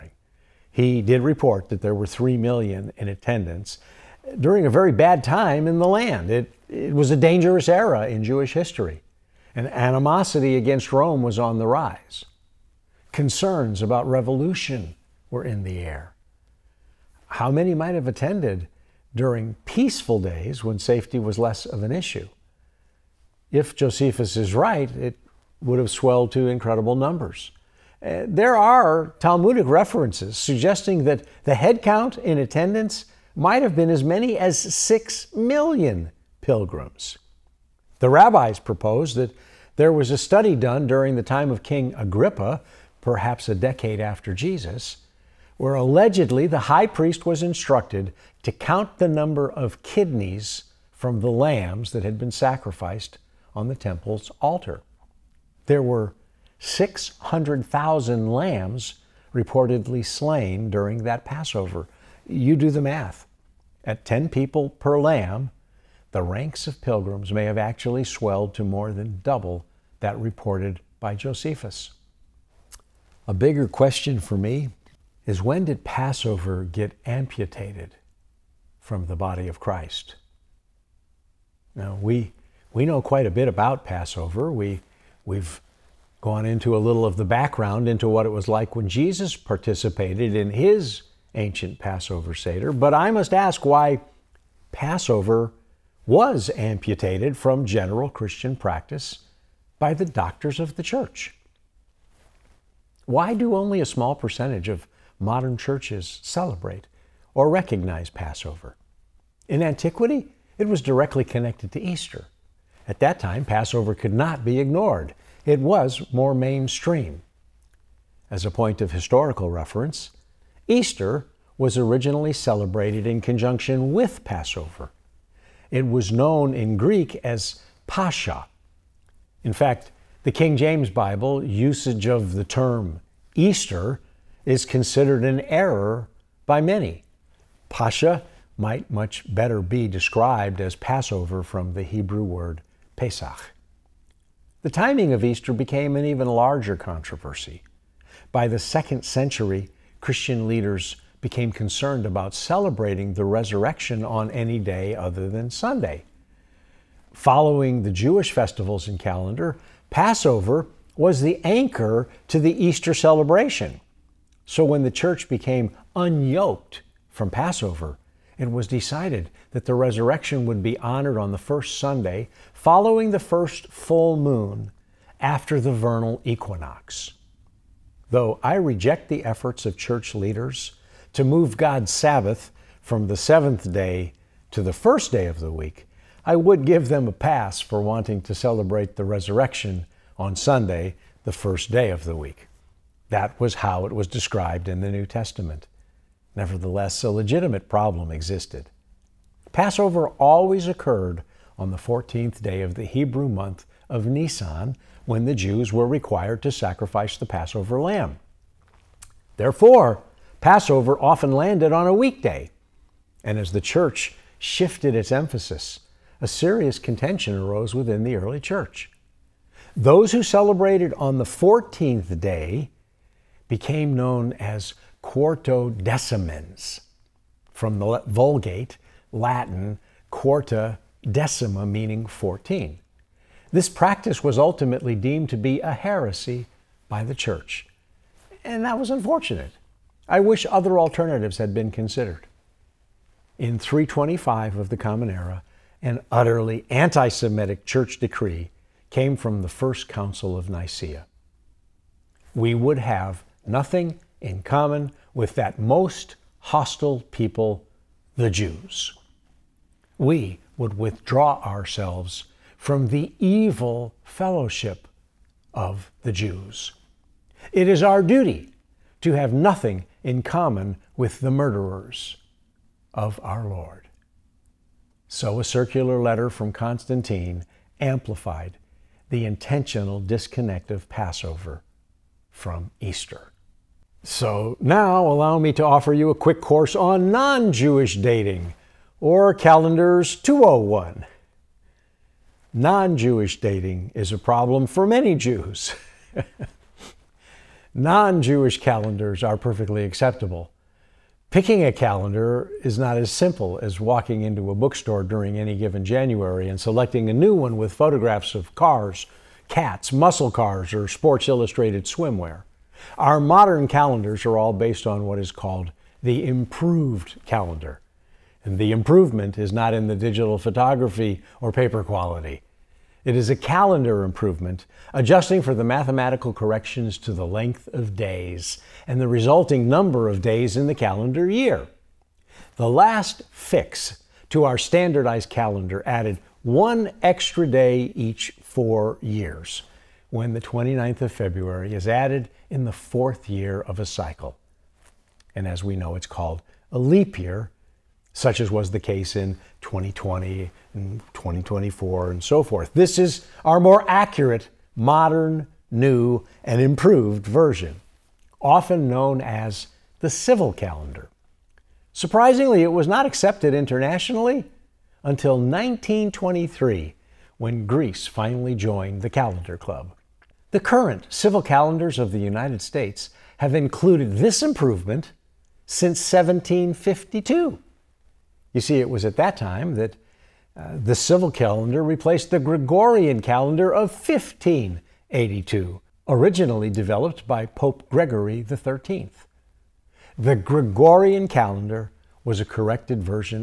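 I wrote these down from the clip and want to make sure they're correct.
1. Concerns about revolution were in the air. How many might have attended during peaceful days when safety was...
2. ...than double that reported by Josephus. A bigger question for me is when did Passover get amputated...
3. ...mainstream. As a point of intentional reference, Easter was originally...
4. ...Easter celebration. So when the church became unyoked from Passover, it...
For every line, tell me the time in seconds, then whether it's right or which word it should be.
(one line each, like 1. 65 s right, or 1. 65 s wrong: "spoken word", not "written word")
1. 13 s right
2. 68 s right
3. 116 s wrong: "historical", not "intentional"
4. 162 s right.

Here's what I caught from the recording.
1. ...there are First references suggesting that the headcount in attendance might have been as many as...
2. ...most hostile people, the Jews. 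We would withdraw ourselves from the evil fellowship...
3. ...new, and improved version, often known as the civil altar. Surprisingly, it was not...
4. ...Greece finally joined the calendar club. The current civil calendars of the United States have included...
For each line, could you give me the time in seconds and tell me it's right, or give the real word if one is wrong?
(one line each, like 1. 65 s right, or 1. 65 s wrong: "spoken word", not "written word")
1. 28 s wrong: "Talmudic", not "First"
2. 255 s right
3. 355 s wrong: "calendar", not "altar"
4. 367 s right.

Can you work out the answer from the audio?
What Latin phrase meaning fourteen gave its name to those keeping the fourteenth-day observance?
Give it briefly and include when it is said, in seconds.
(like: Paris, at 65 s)
quarta decima, at 230 s.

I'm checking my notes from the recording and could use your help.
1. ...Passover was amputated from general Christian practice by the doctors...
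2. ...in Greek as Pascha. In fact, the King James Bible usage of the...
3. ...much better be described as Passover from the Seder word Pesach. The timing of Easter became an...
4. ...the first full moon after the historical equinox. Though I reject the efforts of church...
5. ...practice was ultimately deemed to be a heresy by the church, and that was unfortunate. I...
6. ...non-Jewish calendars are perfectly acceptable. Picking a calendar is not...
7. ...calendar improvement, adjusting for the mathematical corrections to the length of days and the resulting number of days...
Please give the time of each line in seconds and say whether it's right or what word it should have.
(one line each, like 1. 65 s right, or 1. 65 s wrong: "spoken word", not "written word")
1. 94 s right
2. 126 s right
3. 138 s wrong: "Hebrew", not "Seder"
4. 173 s wrong: "vernal", not "historical"
5. 233 s right
6. 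297 s right
7. 323 s right.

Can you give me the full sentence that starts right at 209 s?
Therefore, Passover often landed on a weekday.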